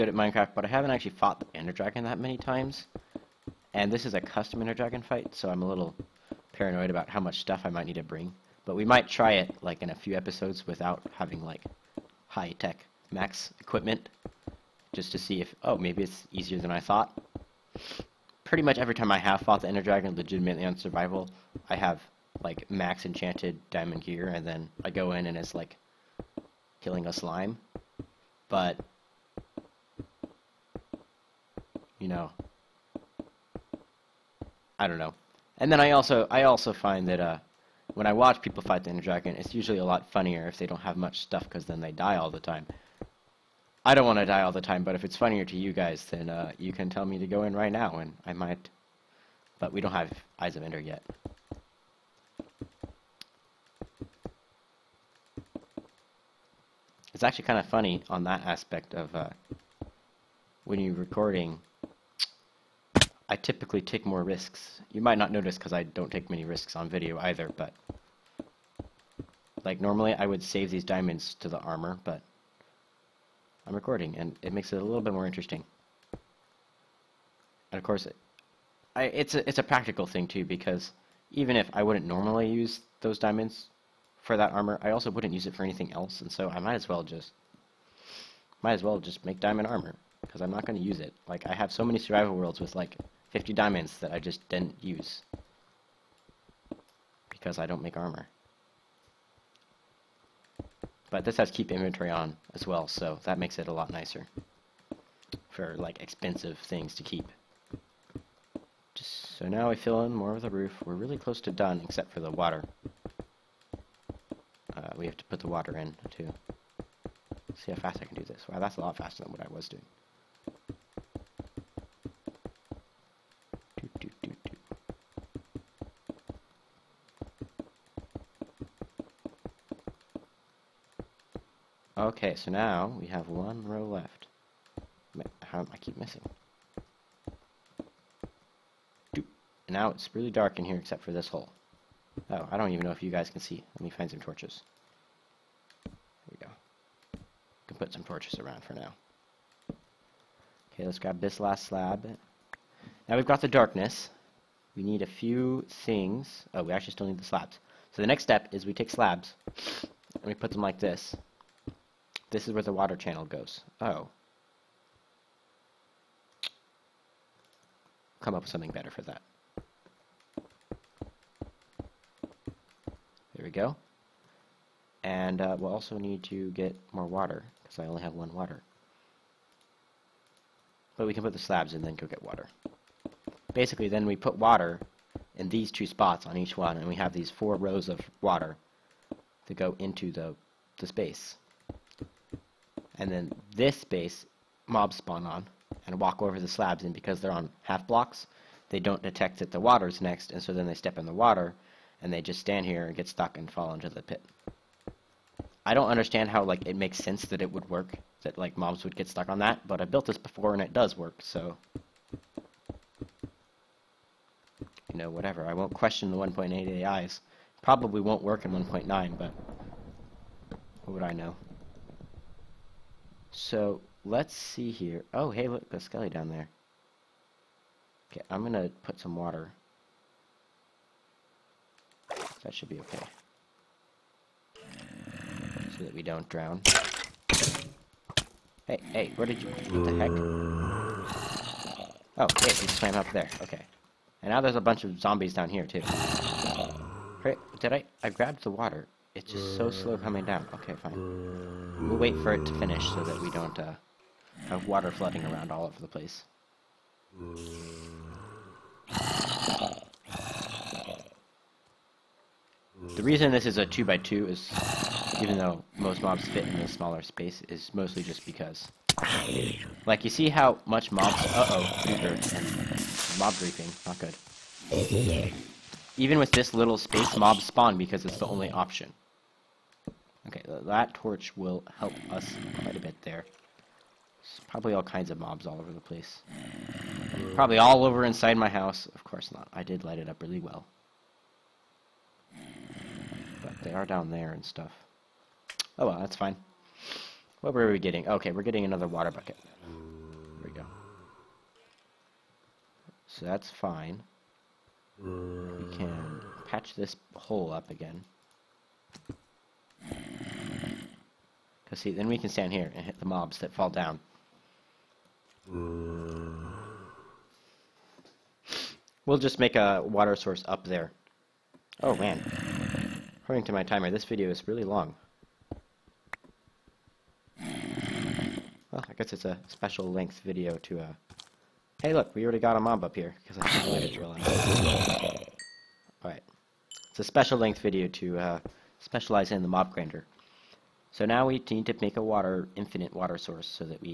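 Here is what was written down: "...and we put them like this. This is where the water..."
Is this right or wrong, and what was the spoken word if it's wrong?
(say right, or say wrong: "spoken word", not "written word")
right.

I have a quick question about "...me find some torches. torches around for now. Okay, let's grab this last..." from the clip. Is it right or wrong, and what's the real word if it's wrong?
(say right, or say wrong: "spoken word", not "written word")
right.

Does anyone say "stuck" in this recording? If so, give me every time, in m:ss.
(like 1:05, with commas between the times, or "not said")
3:23, 3:29.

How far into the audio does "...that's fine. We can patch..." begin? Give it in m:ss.
5:03.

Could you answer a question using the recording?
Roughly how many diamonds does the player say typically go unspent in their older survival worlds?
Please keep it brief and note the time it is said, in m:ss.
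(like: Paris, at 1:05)
50, at 1:33.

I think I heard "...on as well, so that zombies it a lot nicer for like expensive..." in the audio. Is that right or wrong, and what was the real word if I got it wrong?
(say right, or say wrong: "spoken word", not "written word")
wrong: "makes", not "zombies".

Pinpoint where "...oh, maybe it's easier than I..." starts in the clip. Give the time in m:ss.
0:15.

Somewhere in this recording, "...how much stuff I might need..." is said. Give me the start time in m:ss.
0:07.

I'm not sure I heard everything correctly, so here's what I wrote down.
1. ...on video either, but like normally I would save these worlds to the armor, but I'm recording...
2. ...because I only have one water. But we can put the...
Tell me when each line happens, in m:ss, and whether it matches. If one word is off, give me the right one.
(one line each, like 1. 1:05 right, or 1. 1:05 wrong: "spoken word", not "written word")
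1. 1:06 wrong: "diamonds", not "worlds"
2. 2:57 right.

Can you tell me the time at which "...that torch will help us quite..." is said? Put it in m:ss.
4:40.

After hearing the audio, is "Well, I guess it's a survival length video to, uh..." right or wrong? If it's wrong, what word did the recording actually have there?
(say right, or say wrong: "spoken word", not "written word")
wrong: "special", not "survival".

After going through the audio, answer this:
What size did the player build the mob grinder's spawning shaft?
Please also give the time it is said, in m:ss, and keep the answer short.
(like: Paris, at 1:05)
2x2, at 4:23.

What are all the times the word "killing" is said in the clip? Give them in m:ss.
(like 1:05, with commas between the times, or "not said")
0:26.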